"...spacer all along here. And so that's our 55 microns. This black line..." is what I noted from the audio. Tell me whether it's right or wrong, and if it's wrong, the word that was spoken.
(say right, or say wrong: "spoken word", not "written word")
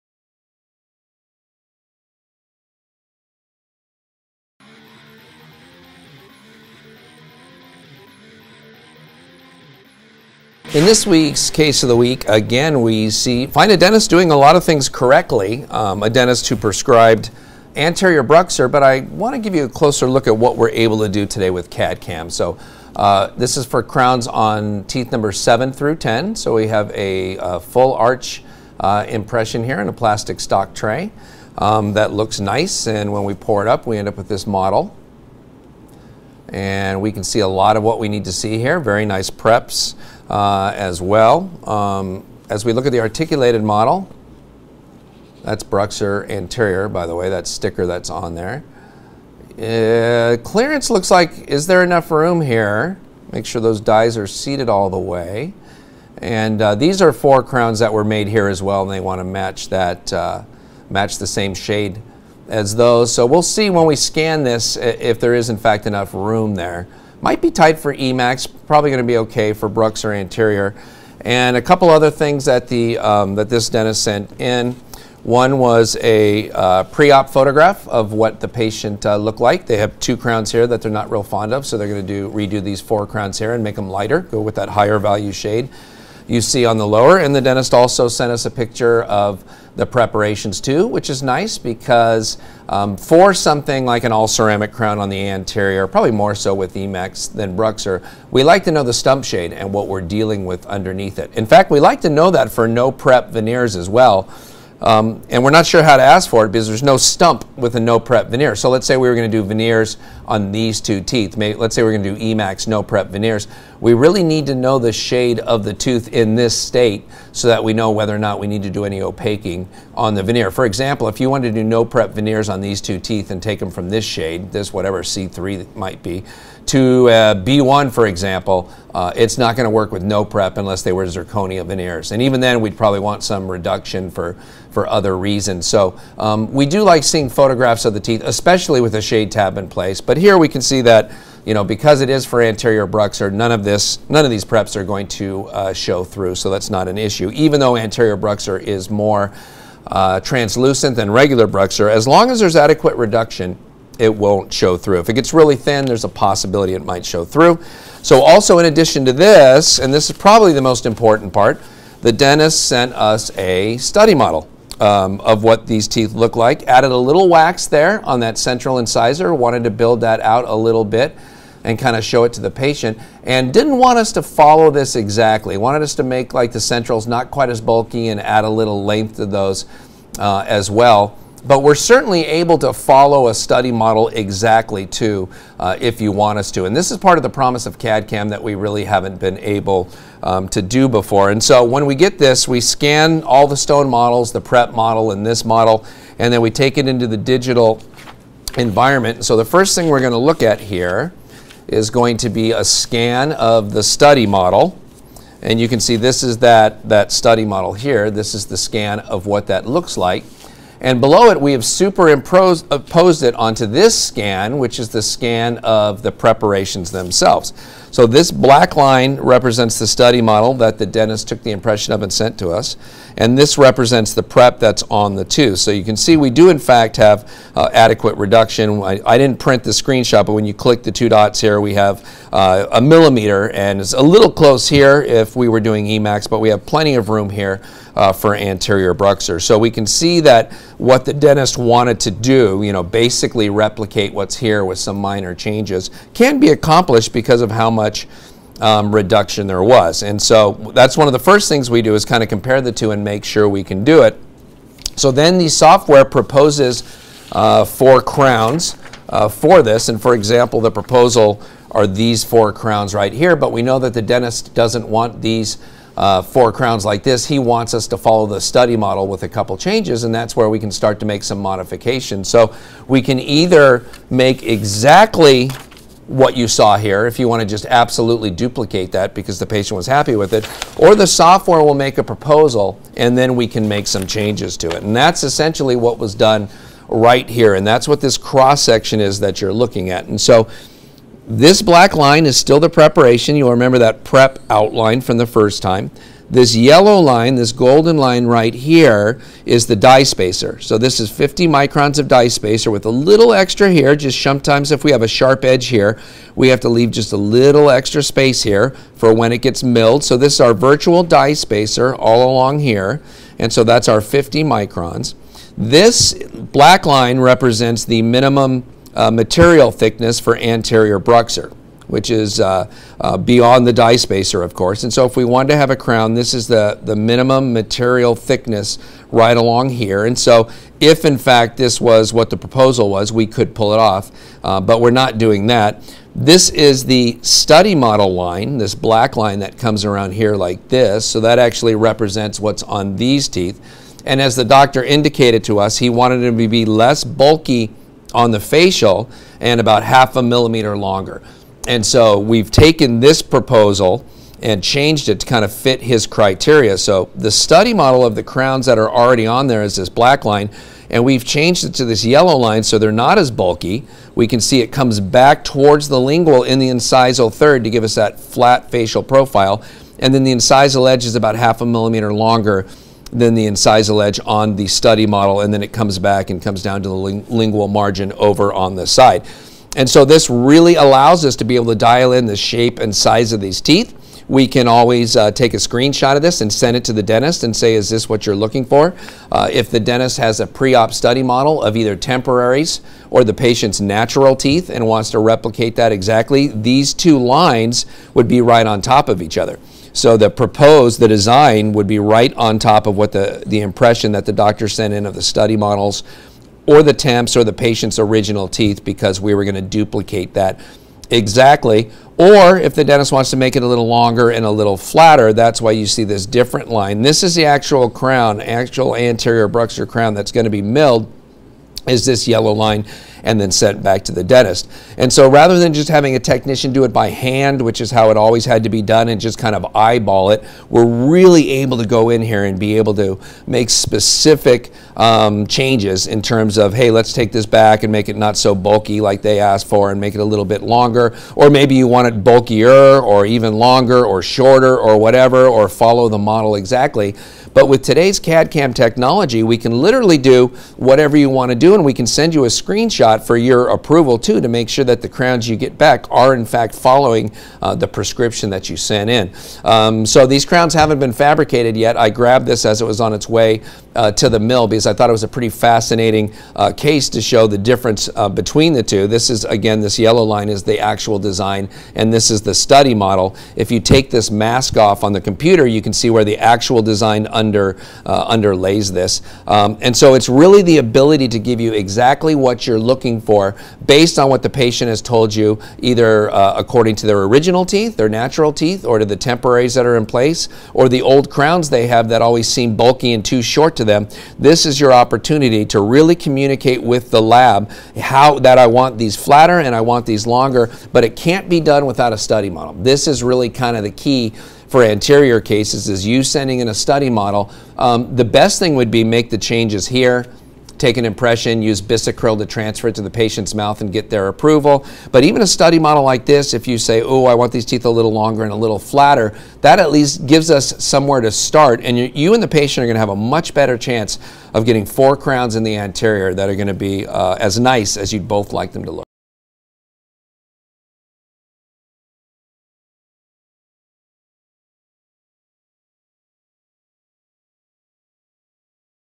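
wrong: "50", not "55".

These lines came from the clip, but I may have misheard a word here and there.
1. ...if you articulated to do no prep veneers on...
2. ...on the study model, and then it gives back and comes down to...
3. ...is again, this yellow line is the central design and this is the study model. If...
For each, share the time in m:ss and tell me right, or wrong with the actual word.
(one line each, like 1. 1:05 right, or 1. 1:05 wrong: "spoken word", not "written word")
1. 2:01 wrong: "wanted", not "articulated"
2. 6:14 wrong: "comes", not "gives"
3. 7:49 wrong: "actual", not "central".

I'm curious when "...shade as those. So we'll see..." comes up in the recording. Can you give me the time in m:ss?
1:01.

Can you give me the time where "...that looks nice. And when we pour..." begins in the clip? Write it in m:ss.
0:31.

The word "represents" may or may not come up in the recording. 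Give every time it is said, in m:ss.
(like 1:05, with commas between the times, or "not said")
3:39, 3:43, 5:17, 5:41.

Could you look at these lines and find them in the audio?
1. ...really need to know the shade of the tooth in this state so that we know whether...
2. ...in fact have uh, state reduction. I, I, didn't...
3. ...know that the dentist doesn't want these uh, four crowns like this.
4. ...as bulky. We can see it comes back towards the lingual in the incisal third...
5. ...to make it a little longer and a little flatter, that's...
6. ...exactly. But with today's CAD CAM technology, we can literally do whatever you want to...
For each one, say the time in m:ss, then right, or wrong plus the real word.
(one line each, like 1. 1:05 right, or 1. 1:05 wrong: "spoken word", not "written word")
1. 1:53 right
2. 3:46 wrong: "adequate", not "state"
3. 4:23 right
4. 6:03 right
5. 6:53 right
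6. 7:26 right.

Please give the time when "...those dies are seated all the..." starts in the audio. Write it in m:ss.
0:53.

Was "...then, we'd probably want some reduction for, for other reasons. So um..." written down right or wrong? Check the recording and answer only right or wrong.
right.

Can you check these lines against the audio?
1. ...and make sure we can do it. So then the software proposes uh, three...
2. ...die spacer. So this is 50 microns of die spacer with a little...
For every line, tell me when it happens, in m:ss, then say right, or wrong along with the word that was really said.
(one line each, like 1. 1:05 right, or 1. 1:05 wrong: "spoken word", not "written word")
1. 4:12 wrong: "four", not "three"
2. 4:59 right.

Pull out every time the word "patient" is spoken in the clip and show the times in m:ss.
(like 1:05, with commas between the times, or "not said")
1:18, 2:52, 4:39, 6:33, 6:47, 8:04, 8:33, 8:42.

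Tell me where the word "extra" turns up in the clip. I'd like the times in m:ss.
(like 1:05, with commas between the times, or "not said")
5:03, 5:07.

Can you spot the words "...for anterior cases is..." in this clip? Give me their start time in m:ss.
8:24.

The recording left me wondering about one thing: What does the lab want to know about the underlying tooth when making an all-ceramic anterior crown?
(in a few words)
stump shade.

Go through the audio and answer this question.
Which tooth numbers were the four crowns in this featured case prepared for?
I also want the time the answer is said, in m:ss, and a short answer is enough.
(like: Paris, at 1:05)
7 through 10, at 0:24.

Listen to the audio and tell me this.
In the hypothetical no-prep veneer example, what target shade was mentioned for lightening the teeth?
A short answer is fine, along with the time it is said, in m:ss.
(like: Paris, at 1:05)
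B1, at 2:07.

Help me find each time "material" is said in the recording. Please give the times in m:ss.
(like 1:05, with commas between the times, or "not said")
5:19, 5:27.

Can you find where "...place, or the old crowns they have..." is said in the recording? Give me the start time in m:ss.
8:10.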